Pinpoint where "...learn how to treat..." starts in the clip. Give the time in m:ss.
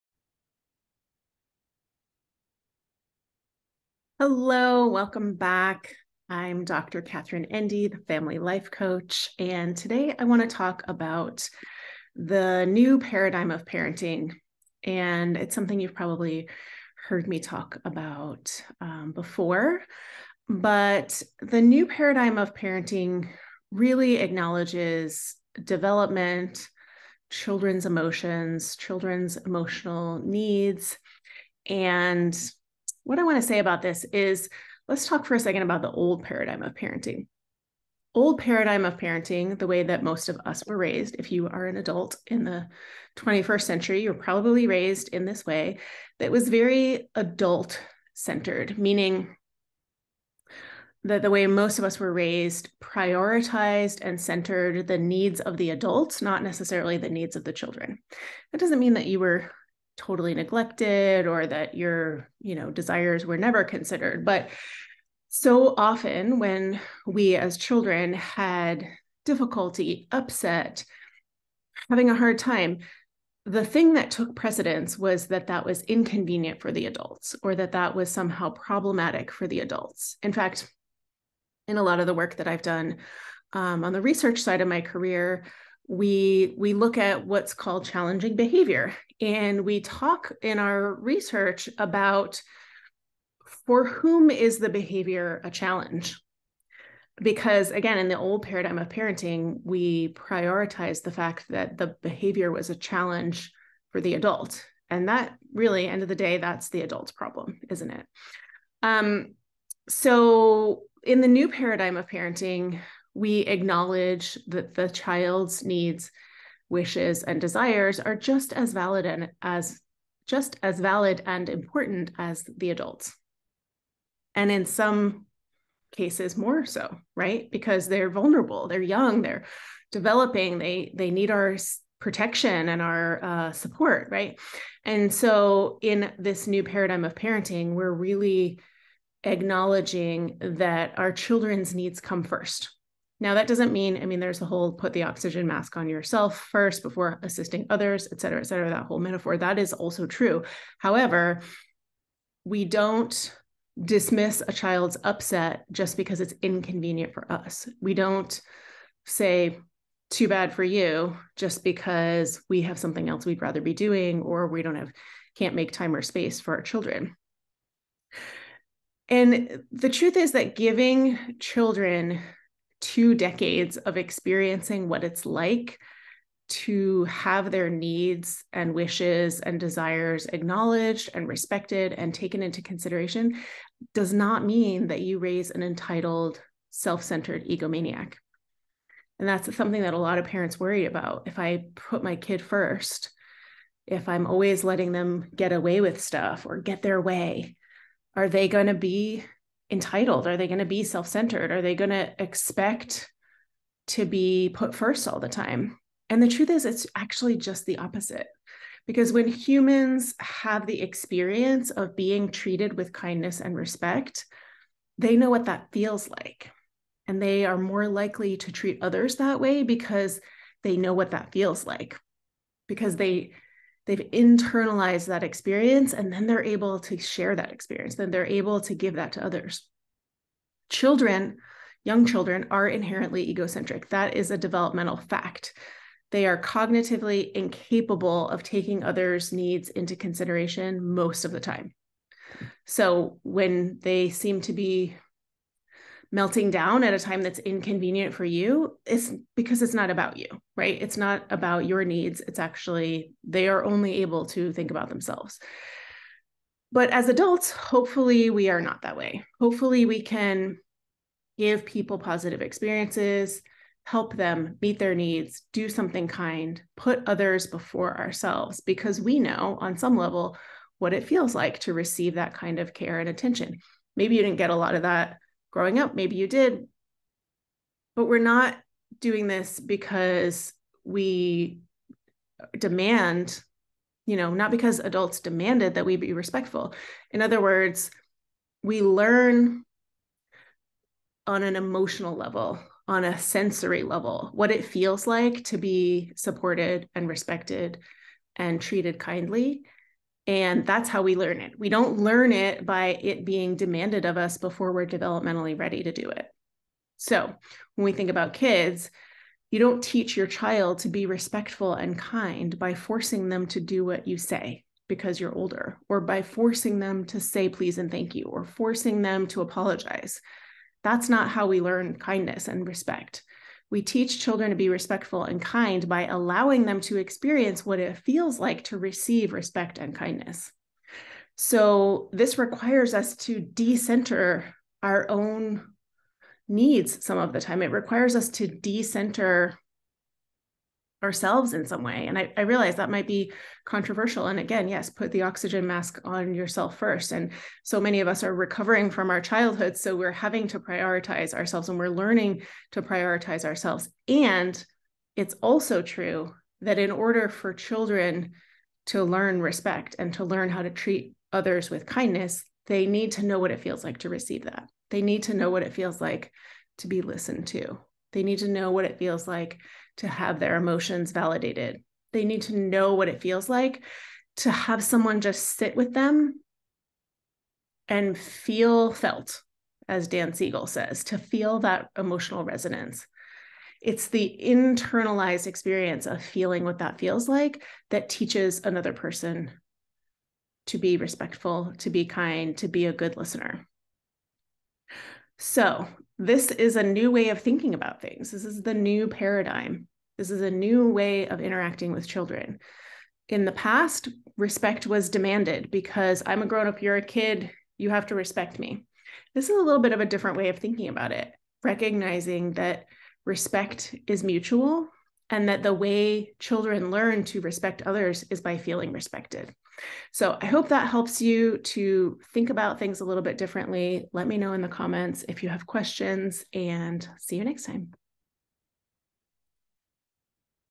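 6:00.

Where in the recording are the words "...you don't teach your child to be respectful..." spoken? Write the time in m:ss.
5:09.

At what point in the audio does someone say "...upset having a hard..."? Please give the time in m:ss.
1:10.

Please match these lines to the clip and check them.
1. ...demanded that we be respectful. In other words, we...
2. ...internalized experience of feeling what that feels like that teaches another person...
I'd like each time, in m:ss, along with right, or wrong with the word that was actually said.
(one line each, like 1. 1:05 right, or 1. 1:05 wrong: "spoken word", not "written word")
1. 4:45 right
2. 6:24 right.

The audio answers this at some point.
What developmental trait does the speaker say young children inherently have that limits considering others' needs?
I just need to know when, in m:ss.
3:53.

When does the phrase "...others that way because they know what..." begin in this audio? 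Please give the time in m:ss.
3:38.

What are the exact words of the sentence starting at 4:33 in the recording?
Maybe you didn't get a lot of that growing up.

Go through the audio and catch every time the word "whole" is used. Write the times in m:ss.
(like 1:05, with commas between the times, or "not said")
2:24, 2:28.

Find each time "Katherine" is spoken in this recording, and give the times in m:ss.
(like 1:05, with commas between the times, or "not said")
0:07.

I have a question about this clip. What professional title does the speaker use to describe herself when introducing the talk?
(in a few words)
family life coach.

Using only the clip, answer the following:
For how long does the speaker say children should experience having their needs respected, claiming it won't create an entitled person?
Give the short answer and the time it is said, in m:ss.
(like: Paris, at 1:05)
two decades, at 2:52.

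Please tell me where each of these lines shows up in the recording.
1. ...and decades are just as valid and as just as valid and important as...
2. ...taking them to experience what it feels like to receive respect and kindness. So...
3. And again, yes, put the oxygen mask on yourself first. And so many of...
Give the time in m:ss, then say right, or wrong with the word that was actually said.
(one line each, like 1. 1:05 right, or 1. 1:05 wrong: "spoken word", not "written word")
1. 1:57 wrong: "desires", not "decades"
2. 5:26 wrong: "allowing", not "taking"
3. 5:44 right.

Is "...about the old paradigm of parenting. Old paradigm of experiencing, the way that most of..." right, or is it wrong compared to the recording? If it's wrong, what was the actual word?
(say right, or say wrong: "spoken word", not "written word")
wrong: "parenting", not "experiencing".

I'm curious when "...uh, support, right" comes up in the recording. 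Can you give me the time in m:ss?
2:13.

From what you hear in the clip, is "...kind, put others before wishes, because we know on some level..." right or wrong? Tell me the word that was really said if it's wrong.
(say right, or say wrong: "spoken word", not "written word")
wrong: "ourselves", not "wishes".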